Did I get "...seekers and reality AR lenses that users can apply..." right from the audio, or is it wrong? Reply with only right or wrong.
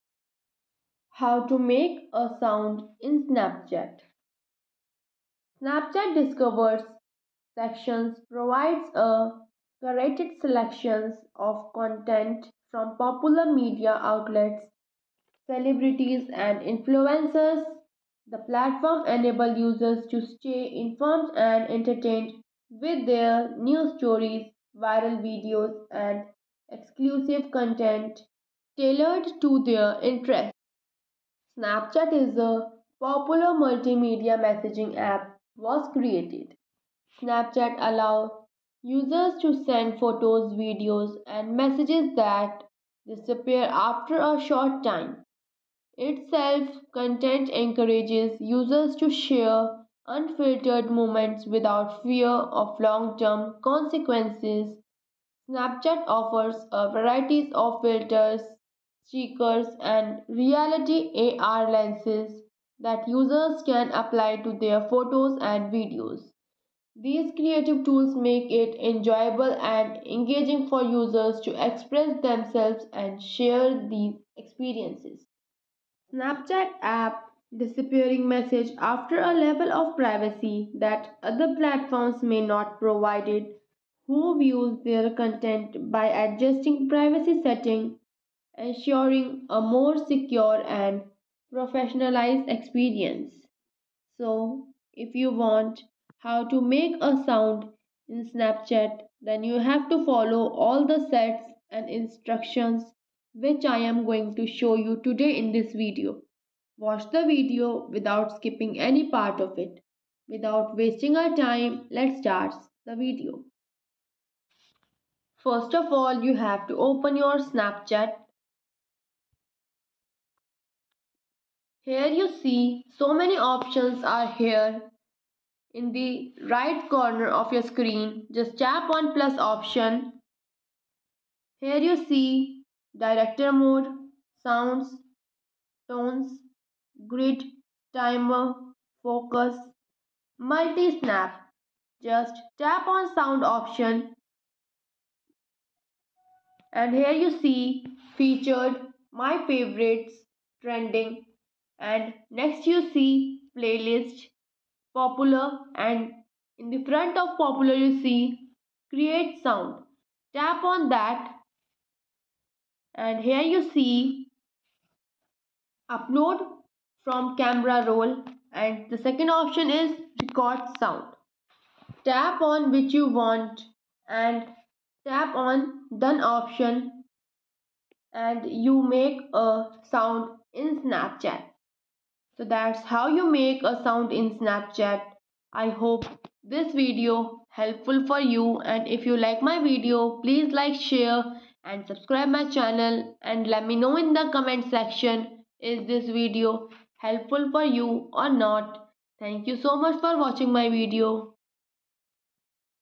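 right.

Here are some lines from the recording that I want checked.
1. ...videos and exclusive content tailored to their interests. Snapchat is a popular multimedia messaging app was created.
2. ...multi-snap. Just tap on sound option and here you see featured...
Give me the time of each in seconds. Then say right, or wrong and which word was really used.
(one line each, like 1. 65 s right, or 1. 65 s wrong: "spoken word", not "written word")
1. 25 s right
2. 140 s right.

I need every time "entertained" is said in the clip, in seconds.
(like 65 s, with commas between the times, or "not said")
21 s.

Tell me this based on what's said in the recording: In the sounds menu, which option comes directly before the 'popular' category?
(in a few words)
create sound.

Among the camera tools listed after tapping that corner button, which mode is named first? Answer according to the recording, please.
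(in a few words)
director mode.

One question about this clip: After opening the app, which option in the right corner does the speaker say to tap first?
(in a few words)
plus.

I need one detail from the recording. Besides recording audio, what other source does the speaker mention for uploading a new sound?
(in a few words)
camera roll.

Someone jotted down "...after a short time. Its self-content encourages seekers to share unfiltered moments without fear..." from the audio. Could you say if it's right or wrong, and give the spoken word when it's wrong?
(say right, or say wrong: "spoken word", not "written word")
wrong: "users", not "seekers".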